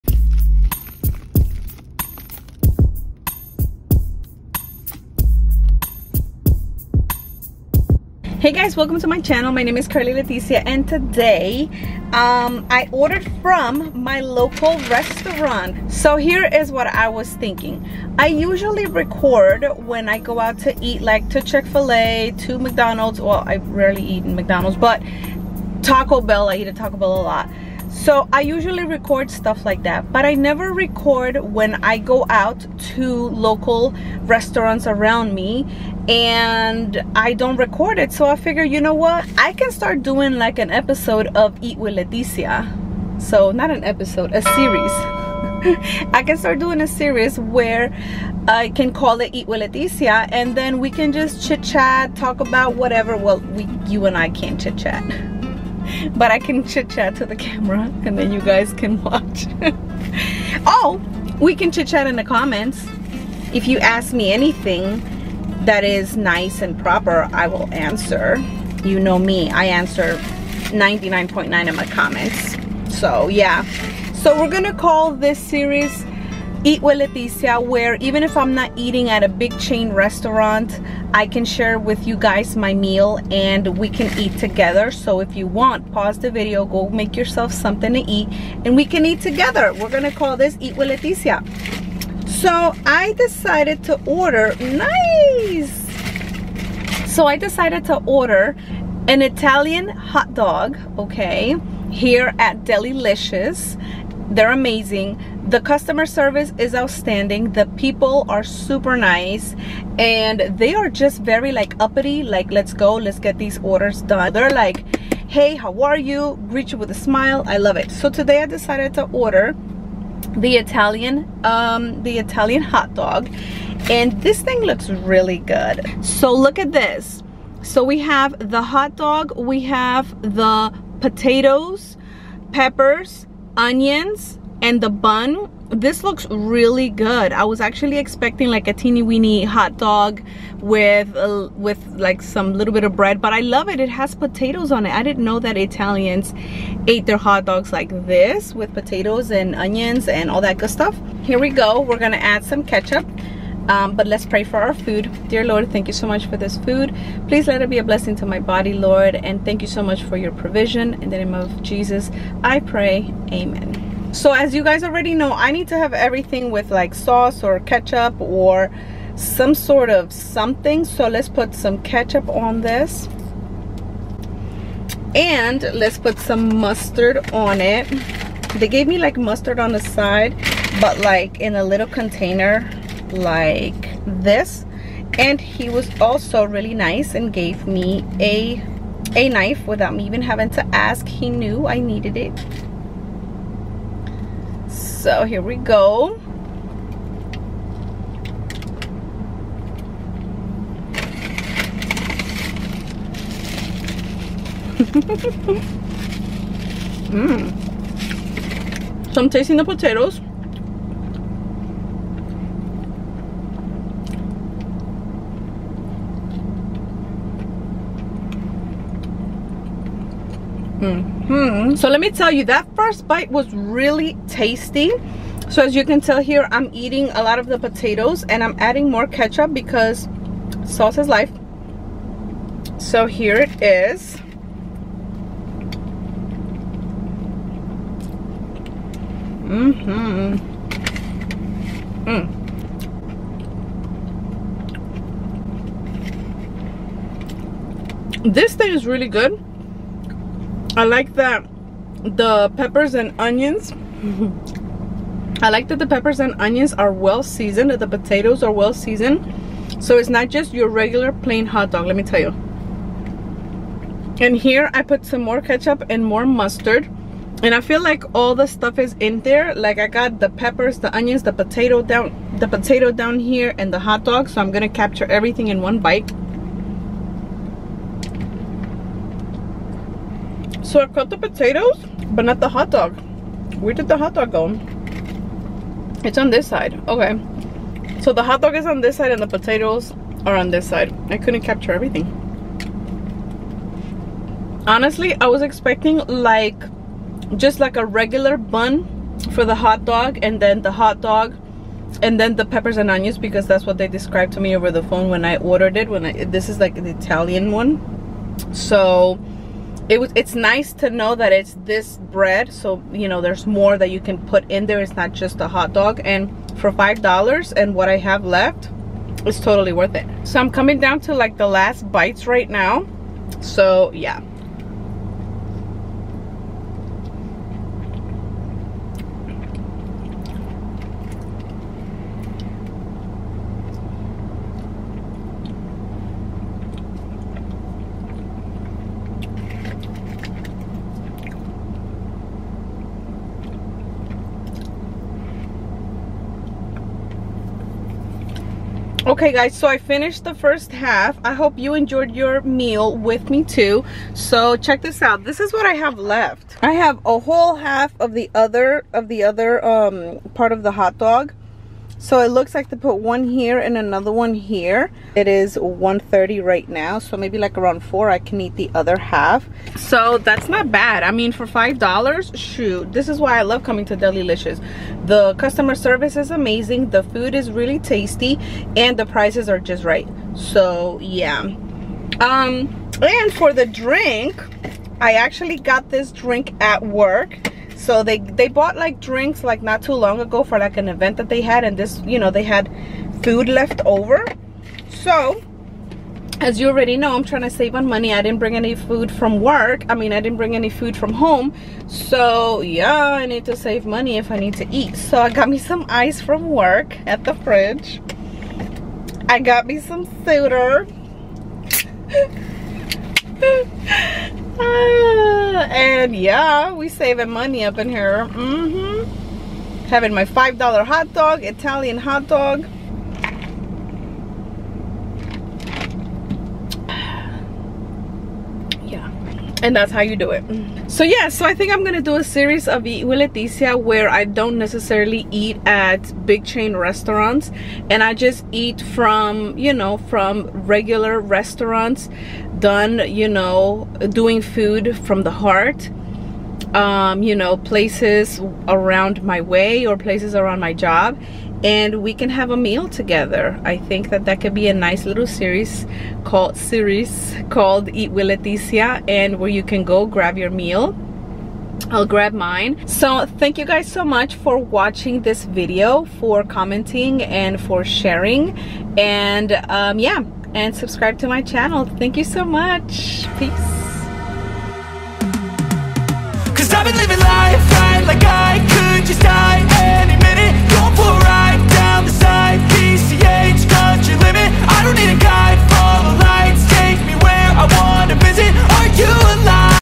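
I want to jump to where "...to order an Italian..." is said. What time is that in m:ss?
1:37.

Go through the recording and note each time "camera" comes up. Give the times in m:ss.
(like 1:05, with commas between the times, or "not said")
0:57.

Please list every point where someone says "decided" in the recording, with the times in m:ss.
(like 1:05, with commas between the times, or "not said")
1:33, 1:37, 1:58.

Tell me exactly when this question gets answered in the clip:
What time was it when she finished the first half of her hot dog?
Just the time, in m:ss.
6:05.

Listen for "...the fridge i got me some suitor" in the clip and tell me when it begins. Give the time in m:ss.
6:47.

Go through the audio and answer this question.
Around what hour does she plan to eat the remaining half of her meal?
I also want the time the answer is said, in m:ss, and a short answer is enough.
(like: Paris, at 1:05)
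4, at 6:07.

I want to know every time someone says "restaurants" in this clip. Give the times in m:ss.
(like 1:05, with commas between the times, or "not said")
0:14, 0:34, 1:19, 7:16, 7:21.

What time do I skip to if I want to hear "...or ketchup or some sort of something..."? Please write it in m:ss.
2:47.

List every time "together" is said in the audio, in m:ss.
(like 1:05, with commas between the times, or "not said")
1:24, 1:29, 7:32.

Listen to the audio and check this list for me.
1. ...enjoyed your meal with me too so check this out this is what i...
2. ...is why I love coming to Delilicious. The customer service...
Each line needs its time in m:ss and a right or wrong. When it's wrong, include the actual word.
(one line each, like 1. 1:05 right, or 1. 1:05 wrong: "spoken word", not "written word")
1. 5:51 right
2. 6:13 right.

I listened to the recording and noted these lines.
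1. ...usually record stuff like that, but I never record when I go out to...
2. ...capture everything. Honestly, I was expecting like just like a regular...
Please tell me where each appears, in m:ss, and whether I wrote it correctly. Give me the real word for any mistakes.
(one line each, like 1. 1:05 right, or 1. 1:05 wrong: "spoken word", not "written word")
1. 0:28 right
2. 4:51 right.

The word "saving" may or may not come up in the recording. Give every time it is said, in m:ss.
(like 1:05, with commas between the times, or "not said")
6:56.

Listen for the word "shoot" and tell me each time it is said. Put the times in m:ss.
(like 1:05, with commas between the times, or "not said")
6:12.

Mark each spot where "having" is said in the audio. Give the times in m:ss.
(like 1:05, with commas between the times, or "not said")
3:10, 6:59.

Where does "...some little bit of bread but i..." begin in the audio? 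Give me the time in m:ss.
2:22.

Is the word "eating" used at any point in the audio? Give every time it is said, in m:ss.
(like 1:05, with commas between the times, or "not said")
1:18, 3:46.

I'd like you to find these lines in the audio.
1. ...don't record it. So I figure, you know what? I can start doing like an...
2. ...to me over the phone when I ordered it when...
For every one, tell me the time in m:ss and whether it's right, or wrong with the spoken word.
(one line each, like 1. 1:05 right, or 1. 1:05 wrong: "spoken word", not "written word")
1. 0:37 right
2. 5:04 right.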